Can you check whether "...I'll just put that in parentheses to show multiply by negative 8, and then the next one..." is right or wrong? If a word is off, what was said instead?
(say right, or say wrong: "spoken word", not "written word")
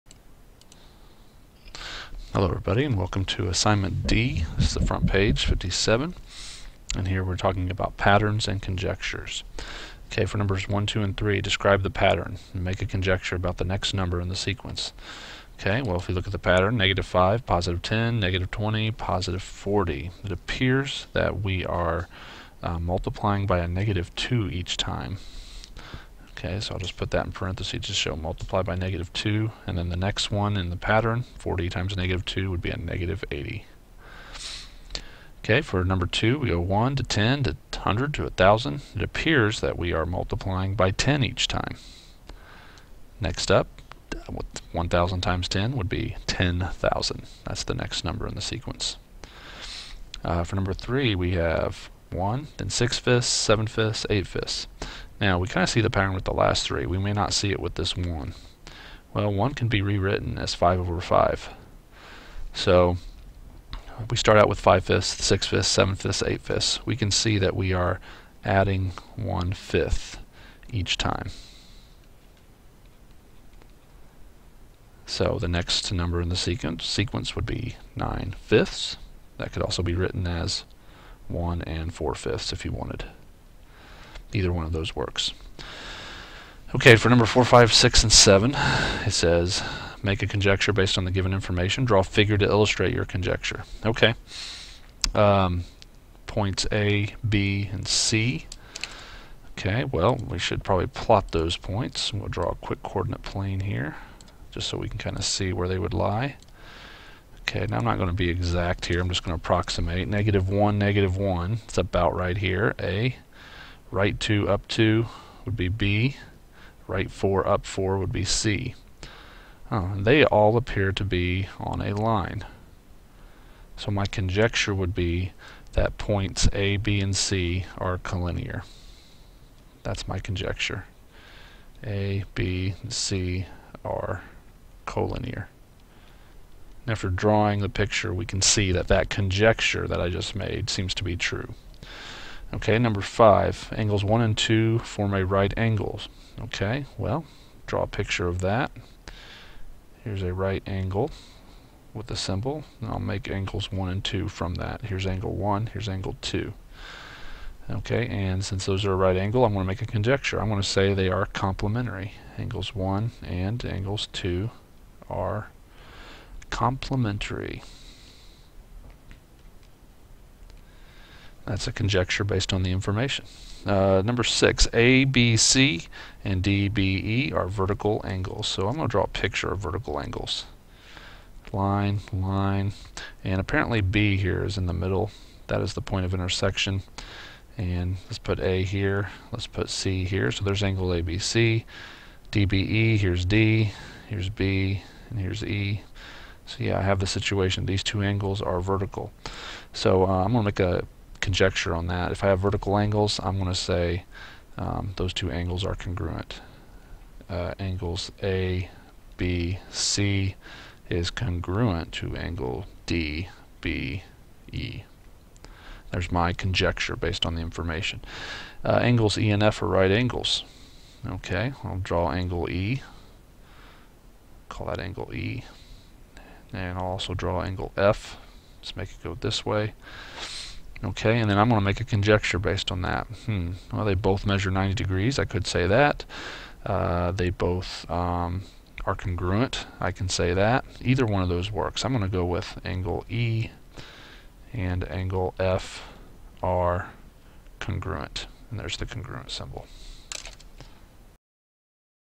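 wrong: "2", not "8".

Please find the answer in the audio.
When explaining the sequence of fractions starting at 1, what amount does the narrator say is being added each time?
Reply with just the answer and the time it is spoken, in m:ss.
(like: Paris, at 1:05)
1/5, at 1:09.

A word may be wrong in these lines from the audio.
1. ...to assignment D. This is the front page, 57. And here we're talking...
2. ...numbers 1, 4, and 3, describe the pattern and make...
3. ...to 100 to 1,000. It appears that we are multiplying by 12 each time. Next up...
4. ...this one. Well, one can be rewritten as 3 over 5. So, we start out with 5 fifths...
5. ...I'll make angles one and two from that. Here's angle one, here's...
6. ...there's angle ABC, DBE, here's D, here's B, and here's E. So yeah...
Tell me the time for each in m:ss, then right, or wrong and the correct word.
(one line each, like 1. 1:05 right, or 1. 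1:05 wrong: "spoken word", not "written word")
1. 0:03 right
2. 0:10 wrong: "2", not "4"
3. 0:37 wrong: "10", not "12"
4. 0:57 wrong: "5", not "3"
5. 2:32 right
6. 3:10 right.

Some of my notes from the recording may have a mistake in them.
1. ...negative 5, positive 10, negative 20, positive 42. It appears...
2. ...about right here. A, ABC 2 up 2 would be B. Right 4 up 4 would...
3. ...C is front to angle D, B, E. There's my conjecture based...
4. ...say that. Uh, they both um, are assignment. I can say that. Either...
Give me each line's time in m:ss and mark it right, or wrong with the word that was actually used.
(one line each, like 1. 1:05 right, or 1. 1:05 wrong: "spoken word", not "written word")
1. 0:16 wrong: "40", not "42"
2. 1:51 wrong: "Right", not "ABC"
3. 3:29 wrong: "congruent", not "front"
4. 3:55 wrong: "congruent", not "assignment".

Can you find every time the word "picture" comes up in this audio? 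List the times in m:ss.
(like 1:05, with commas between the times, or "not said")
2:17, 2:27, 2:59.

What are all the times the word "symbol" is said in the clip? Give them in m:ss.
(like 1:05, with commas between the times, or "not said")
2:32, 4:09.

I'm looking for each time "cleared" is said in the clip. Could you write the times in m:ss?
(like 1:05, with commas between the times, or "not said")
not said.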